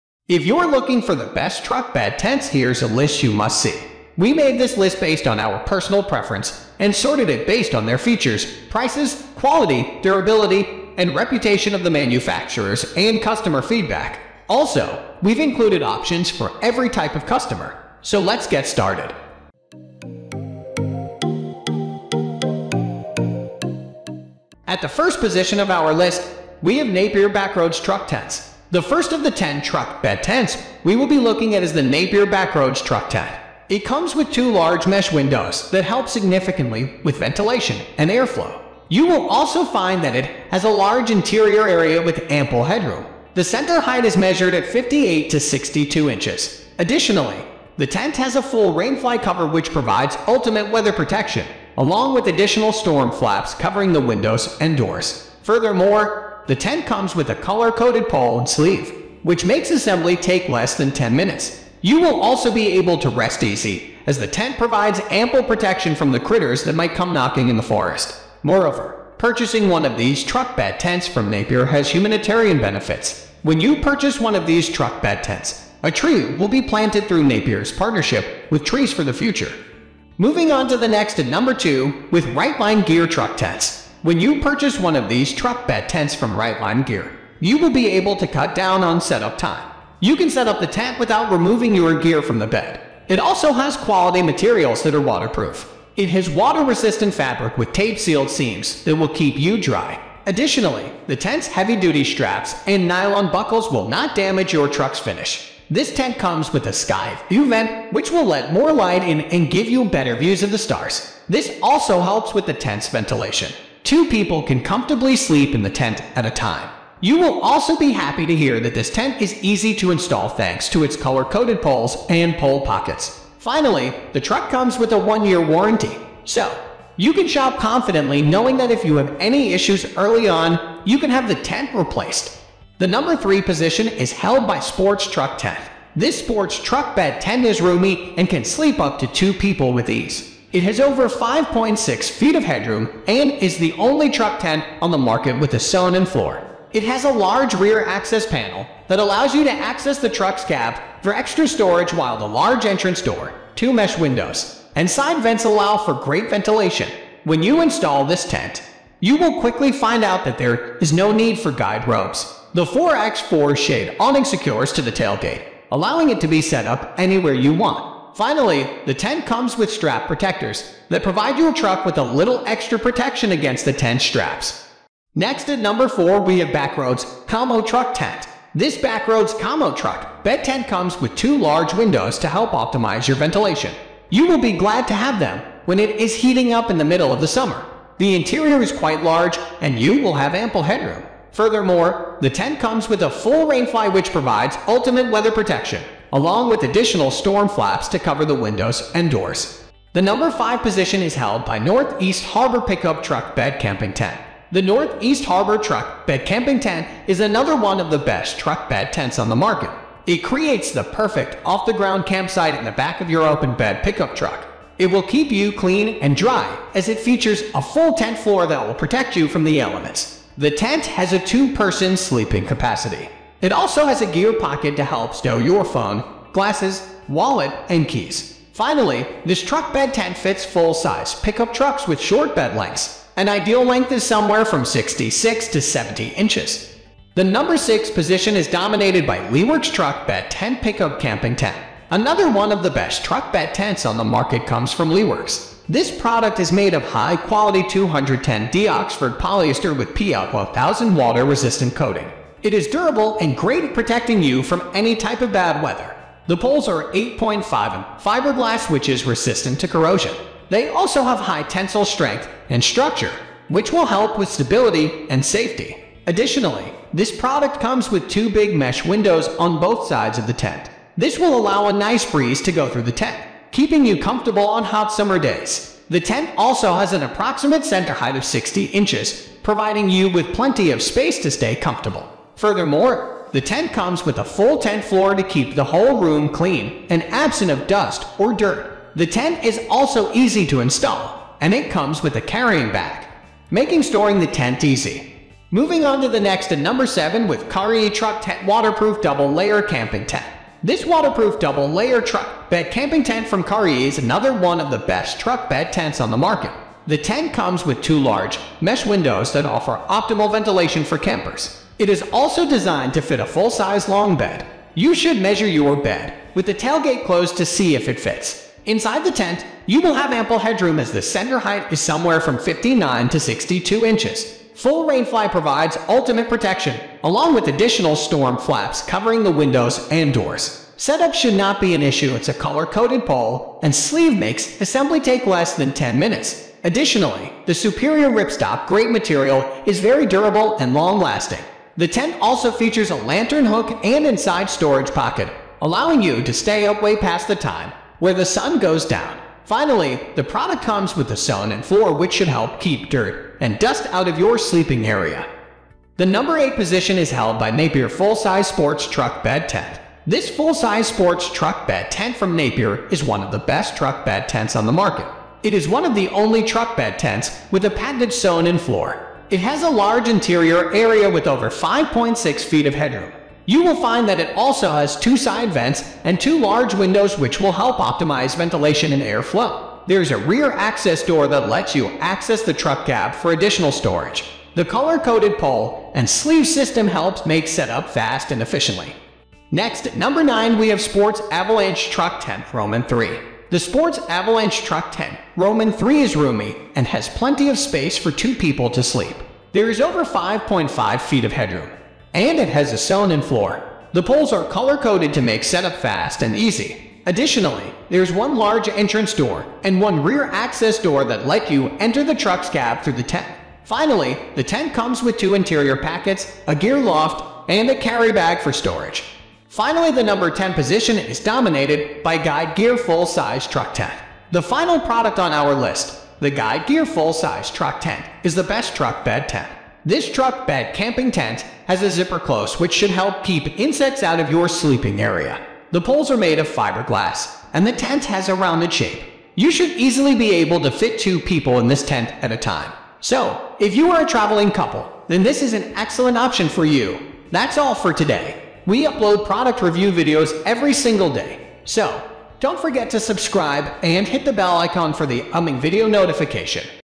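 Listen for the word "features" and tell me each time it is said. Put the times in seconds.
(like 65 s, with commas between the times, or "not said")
7 s, 216 s, 342 s.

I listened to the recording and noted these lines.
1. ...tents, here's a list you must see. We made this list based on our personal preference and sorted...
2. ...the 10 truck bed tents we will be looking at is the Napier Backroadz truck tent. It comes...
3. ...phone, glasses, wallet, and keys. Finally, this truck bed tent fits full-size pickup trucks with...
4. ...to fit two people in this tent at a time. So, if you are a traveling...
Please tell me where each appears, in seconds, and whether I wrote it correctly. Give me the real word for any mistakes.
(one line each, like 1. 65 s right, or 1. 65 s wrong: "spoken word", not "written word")
1. 2 s right
2. 29 s right
3. 225 s right
4. 440 s right.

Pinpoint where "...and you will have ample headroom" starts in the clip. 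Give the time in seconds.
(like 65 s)
189 s.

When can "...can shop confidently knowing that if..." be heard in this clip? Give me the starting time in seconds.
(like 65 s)
127 s.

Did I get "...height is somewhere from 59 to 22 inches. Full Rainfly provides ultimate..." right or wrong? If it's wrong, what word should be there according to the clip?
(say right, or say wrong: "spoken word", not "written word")
wrong: "62", not "22".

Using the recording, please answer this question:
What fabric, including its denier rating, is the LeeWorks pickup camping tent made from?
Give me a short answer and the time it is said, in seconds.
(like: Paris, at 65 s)
210D Oxford polyester, at 247 s.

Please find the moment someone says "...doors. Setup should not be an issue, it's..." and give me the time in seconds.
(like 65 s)
330 s.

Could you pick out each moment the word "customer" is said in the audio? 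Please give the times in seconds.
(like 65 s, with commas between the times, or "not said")
13 s, 17 s.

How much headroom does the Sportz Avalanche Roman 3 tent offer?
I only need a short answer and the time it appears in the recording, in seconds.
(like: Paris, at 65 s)
over 5.5 feet, at 399 s.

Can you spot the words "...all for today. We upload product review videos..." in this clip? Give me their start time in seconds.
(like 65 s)
447 s.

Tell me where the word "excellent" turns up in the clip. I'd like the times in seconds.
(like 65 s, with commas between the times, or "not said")
445 s.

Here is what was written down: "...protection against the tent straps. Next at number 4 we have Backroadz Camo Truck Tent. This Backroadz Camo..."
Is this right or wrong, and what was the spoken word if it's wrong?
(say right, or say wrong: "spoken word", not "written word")
right.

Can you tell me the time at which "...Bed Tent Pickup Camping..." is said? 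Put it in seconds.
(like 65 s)
240 s.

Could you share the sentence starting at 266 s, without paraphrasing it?
Additionally, this product comes with two big mesh windows on both sides of the tent.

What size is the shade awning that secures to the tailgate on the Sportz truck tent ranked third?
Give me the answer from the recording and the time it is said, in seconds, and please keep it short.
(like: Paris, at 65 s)
4x4, at 162 s.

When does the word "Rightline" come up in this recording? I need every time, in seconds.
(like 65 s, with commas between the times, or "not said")
82 s, 86 s.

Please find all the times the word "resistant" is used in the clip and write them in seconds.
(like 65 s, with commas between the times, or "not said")
96 s, 250 s, 259 s.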